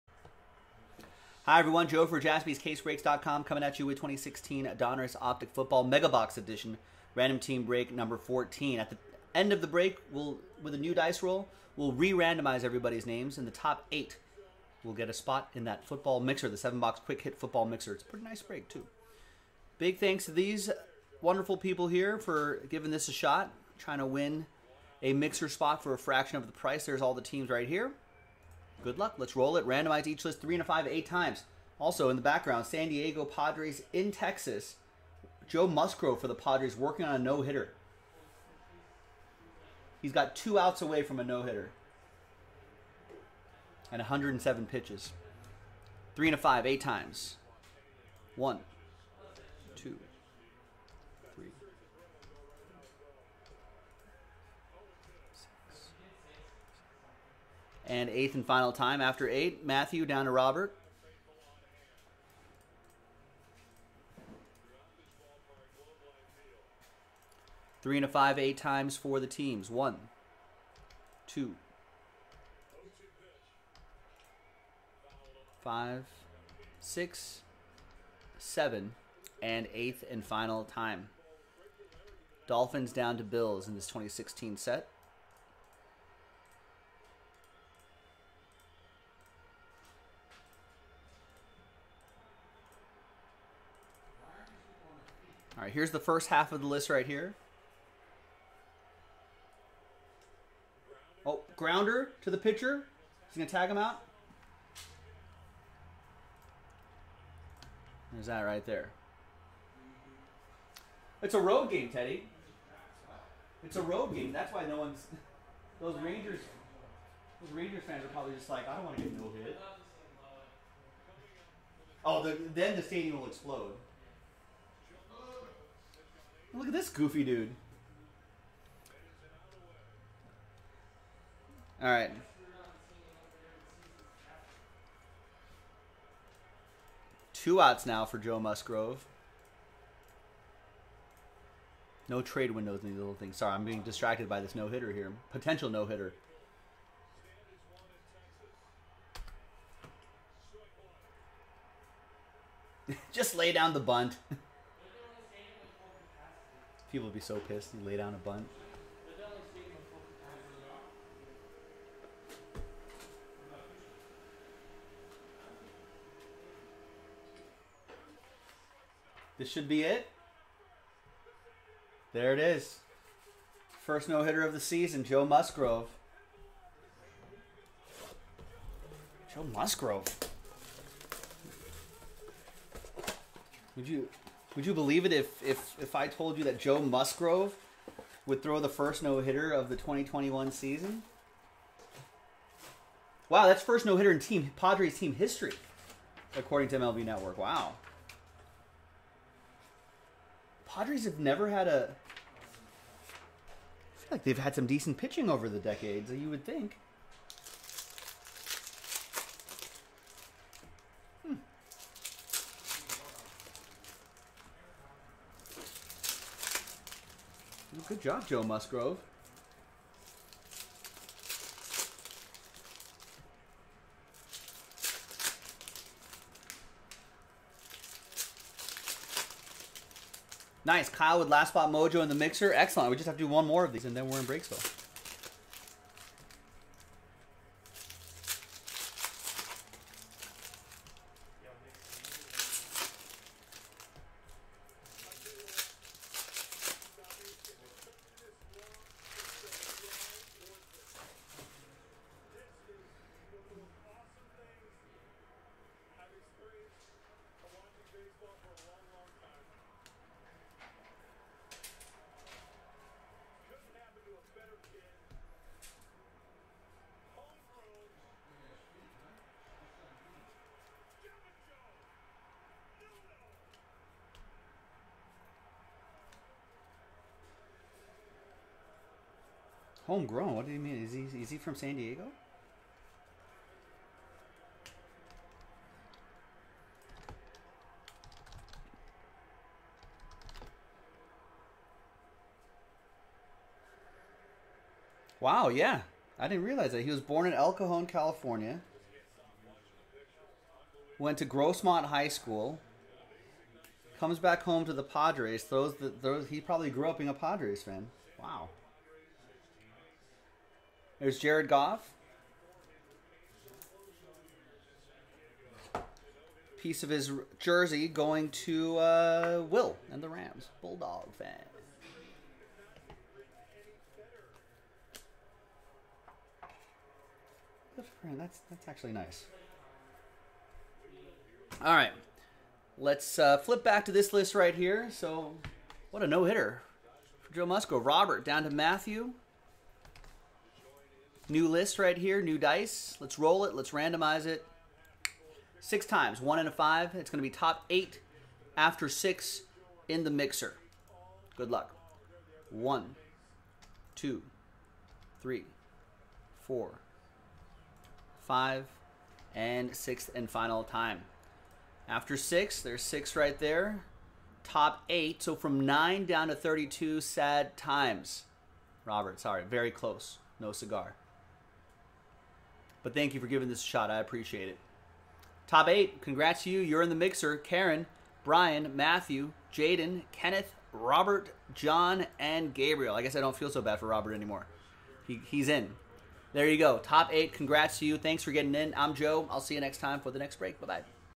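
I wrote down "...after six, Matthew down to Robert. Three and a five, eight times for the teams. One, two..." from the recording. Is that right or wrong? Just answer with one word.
wrong.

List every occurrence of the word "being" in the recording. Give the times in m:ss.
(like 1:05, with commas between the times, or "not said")
2:23, 5:06.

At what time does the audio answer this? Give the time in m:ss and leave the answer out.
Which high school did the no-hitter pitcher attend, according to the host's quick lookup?
5:01.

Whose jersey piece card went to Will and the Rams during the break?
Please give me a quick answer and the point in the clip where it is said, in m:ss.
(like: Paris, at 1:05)
Jared Goff, at 5:11.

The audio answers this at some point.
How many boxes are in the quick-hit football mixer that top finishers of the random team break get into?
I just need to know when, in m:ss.
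0:16.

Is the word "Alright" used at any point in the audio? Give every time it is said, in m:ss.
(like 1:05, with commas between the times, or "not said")
2:11.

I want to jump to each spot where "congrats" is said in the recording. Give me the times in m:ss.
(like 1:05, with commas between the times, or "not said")
6:16, 6:27.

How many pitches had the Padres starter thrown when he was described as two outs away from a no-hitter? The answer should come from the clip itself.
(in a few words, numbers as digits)
107.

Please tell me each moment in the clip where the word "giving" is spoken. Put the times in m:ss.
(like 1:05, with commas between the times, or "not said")
0:22, 6:13.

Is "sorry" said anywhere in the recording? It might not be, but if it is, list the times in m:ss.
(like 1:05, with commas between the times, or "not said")
2:23, 6:09.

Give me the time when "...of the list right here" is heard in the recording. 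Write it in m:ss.
1:36.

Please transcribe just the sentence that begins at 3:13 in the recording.
Wow, that's first no hitter in team Padres team history, according to MLB Network.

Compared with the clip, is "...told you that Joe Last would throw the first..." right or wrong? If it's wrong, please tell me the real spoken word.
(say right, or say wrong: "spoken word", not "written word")
wrong: "Musgrove", not "Last".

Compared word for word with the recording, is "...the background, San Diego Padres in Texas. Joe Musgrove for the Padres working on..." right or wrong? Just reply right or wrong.
right.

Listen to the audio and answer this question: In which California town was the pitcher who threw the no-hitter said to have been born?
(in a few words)
El Cajon.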